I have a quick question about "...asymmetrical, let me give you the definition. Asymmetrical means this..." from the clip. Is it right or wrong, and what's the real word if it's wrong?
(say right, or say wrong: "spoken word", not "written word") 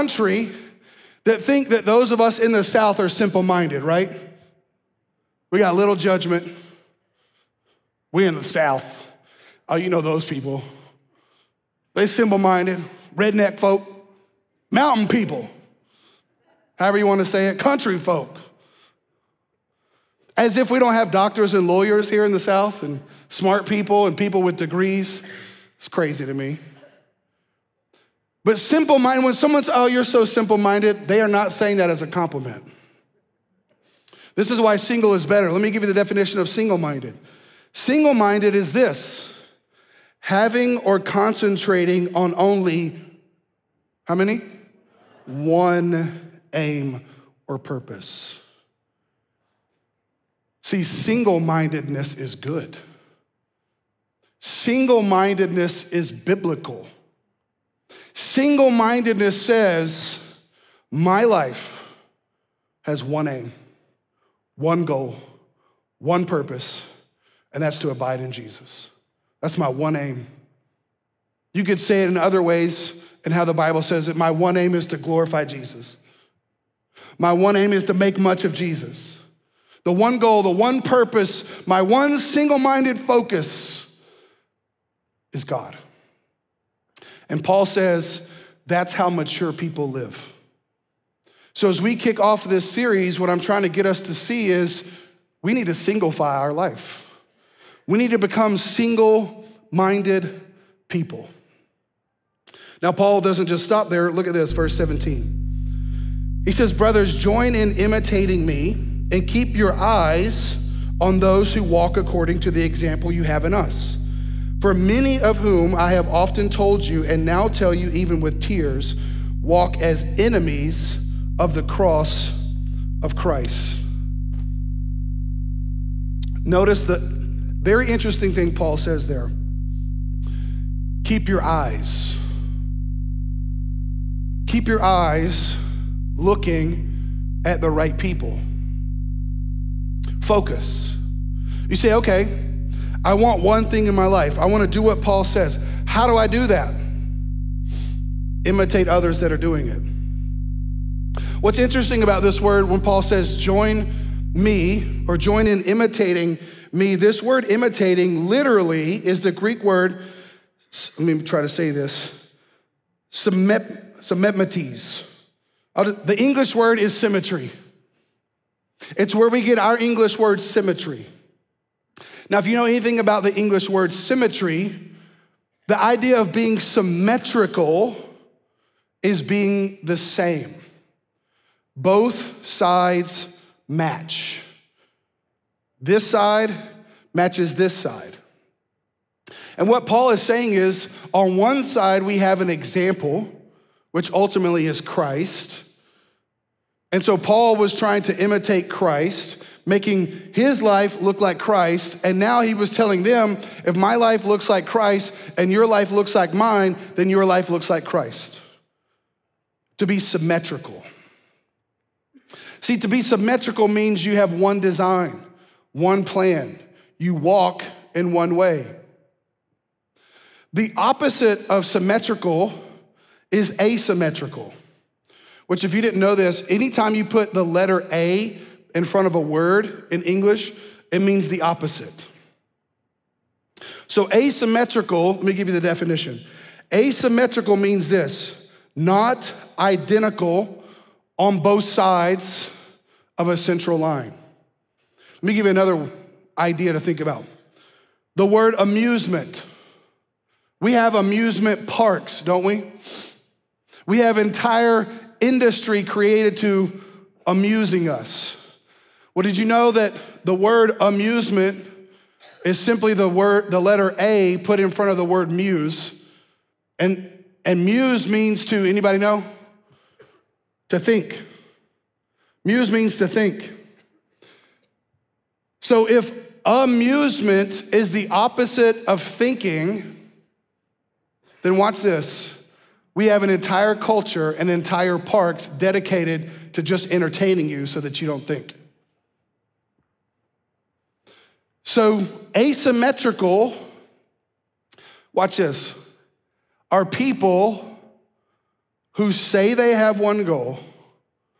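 right.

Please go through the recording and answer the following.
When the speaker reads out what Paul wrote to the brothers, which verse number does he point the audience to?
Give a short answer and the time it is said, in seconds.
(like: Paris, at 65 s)
17, at 104 s.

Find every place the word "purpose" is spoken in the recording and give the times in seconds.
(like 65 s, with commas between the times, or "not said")
47 s, 66 s, 80 s.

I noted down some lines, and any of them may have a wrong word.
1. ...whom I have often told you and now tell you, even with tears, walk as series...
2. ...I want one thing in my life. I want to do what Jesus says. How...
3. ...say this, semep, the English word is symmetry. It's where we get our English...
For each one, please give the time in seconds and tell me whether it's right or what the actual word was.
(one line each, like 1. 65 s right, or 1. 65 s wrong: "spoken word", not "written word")
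1. 115 s wrong: "enemies", not "series"
2. 143 s wrong: "Paul", not "Jesus"
3. 161 s right.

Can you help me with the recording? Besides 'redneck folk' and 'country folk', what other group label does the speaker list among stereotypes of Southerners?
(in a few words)
mountain people.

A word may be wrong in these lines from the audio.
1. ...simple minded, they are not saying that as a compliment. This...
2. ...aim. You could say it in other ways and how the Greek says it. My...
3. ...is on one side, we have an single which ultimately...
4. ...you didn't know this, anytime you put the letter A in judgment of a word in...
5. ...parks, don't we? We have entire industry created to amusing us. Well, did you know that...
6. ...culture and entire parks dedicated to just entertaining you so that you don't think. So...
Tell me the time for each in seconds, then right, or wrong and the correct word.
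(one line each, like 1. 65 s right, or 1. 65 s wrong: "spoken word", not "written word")
1. 30 s right
2. 69 s wrong: "Bible", not "Greek"
3. 190 s wrong: "example", not "single"
4. 225 s wrong: "front", not "judgment"
5. 251 s right
6. 283 s right.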